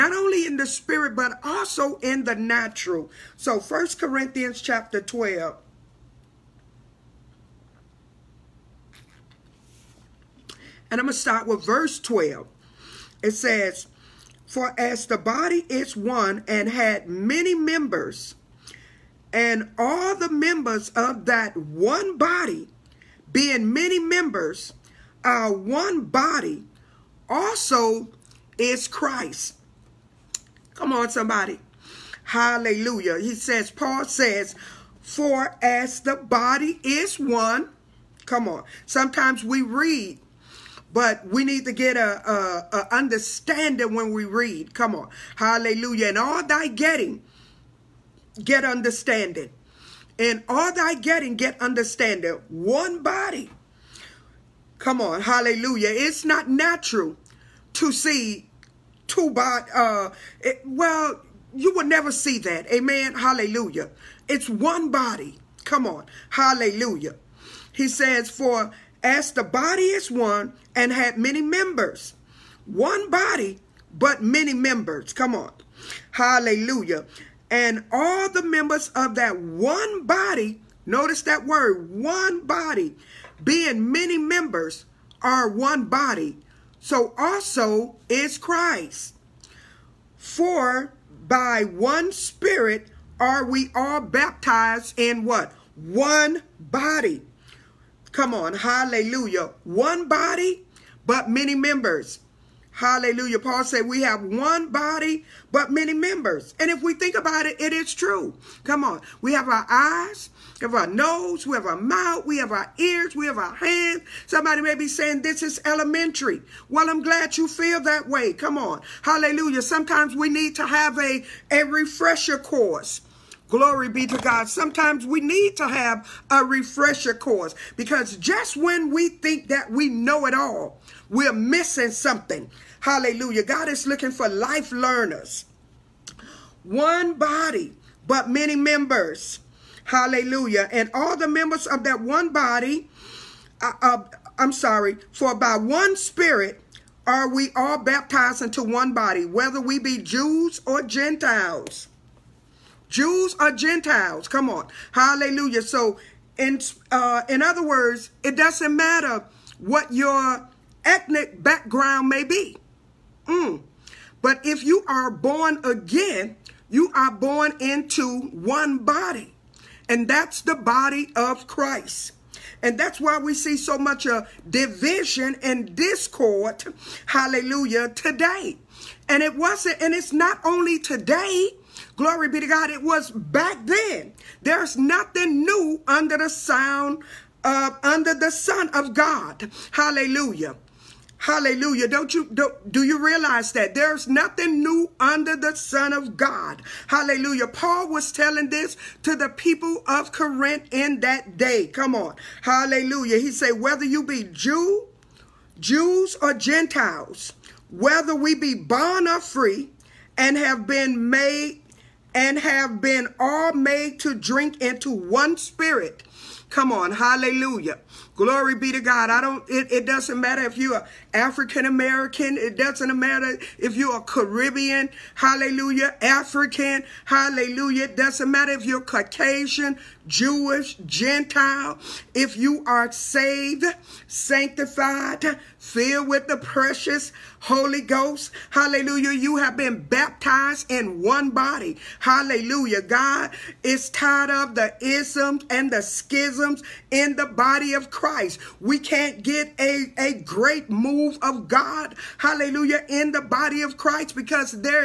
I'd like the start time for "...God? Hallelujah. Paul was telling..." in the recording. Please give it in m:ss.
3:16.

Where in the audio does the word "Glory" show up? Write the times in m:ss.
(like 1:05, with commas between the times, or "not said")
2:03, 3:01, 3:38.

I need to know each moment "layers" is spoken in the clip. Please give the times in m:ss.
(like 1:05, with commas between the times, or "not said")
not said.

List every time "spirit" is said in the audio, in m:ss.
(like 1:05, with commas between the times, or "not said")
0:00, 1:32, 2:25, 3:35.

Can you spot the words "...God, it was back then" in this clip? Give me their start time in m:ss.
3:02.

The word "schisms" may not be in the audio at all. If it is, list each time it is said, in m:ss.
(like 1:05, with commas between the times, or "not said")
4:05.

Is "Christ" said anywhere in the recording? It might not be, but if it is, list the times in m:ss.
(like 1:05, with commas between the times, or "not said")
0:28, 1:28, 2:51, 4:07, 4:13.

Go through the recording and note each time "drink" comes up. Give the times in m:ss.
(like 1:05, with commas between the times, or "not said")
3:34.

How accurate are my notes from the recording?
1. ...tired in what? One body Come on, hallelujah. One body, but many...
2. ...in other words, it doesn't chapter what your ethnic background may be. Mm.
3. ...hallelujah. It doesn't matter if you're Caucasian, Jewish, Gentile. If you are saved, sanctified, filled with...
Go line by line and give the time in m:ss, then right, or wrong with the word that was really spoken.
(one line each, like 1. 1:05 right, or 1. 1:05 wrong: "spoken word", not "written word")
1. 1:34 wrong: "baptized", not "tired"
2. 2:37 wrong: "matter", not "chapter"
3. 3:47 right.